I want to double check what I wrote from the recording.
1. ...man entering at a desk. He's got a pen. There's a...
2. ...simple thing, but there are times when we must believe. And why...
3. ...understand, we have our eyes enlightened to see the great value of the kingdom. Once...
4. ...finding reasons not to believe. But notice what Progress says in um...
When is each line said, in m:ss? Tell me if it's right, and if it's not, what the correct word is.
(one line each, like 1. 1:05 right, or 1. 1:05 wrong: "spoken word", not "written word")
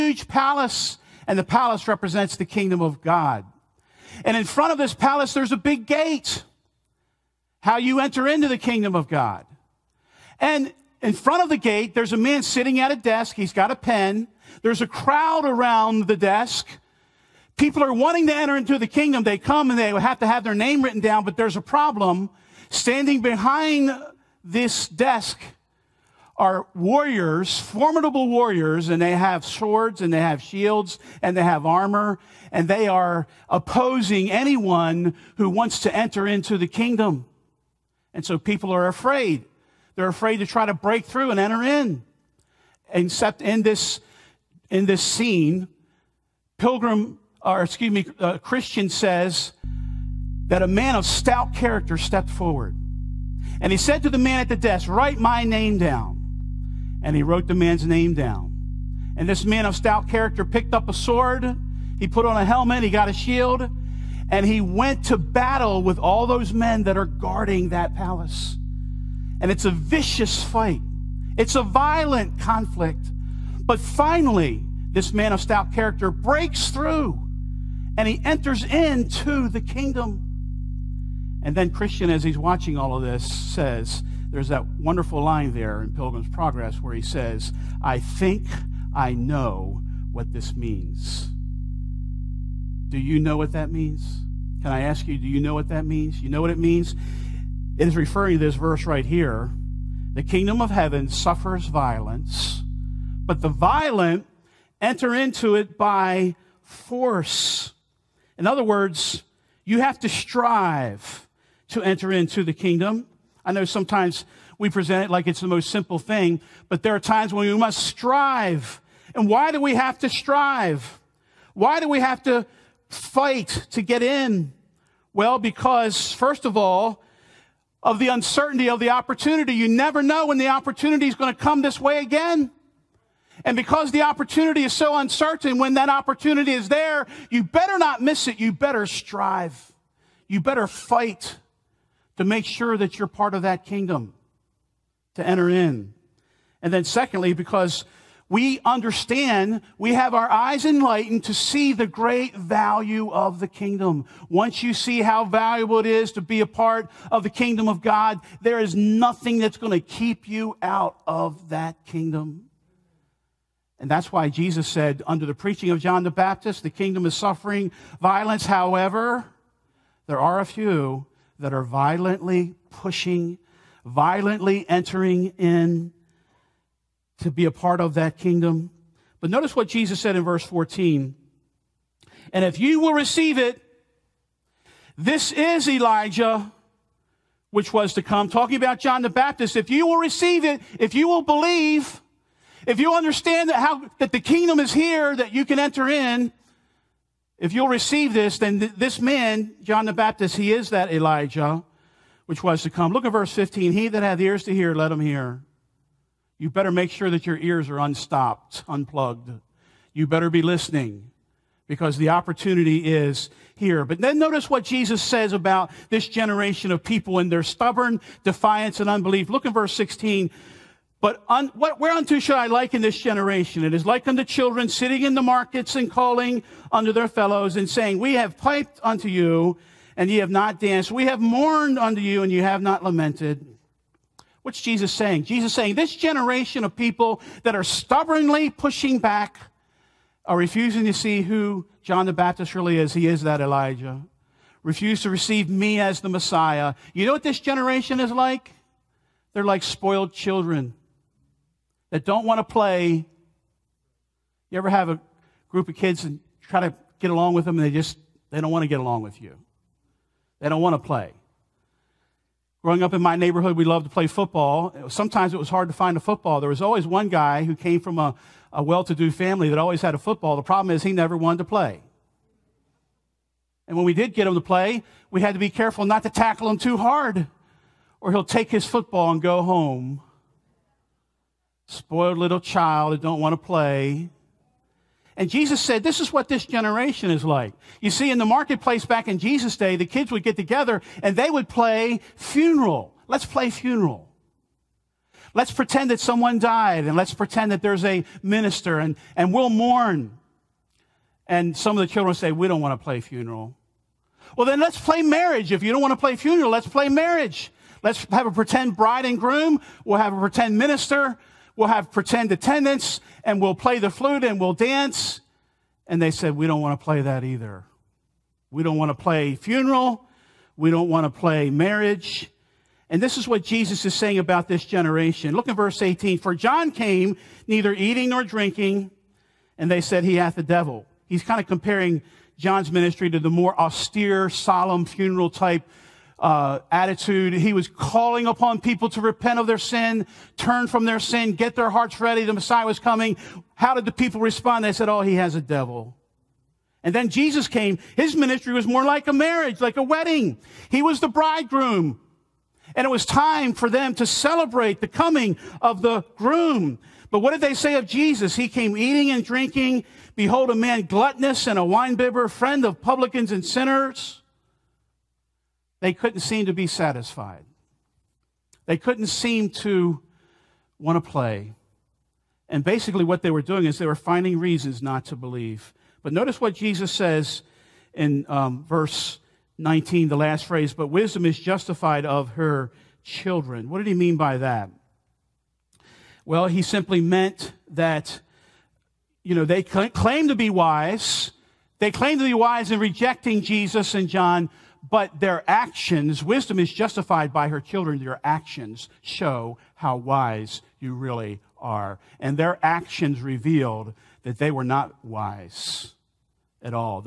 1. 0:12 wrong: "sitting", not "entering"
2. 1:55 wrong: "strive", not "believe"
3. 2:28 right
4. 6:13 wrong: "Jesus", not "Progress".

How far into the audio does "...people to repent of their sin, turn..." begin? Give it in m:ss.
5:38.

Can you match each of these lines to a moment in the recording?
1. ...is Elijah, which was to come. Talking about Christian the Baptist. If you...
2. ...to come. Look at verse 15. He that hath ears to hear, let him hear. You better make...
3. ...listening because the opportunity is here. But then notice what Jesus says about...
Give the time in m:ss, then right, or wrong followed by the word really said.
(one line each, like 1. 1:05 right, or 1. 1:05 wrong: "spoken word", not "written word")
1. 3:05 wrong: "John", not "Christian"
2. 3:22 right
3. 3:30 right.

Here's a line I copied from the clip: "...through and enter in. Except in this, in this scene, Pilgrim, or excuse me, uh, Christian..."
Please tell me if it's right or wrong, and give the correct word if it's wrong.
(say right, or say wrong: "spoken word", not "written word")
right.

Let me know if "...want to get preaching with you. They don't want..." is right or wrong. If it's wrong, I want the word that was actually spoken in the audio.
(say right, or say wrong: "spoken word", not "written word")
wrong: "along", not "preaching".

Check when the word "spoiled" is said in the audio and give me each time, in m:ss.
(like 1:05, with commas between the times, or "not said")
4:09, 4:41.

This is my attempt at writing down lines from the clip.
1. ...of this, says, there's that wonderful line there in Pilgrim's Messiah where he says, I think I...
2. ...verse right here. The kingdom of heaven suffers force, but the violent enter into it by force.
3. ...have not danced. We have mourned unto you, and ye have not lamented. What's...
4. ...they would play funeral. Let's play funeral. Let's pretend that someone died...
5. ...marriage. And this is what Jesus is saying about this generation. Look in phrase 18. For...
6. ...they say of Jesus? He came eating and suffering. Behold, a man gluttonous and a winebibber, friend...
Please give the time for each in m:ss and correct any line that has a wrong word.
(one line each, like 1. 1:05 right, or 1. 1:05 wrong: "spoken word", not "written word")
1. 1:22 wrong: "Progress", not "Messiah"
2. 1:38 wrong: "violence", not "force"
3. 3:50 right
4. 4:51 right
5. 5:21 wrong: "verse", not "phrase"
6. 5:57 wrong: "drinking", not "suffering".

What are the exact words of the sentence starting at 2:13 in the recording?
And because the opportunity is so uncertain, when that opportunity is there, you better not miss it.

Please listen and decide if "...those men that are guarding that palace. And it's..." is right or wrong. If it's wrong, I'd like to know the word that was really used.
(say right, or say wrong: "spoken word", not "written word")
right.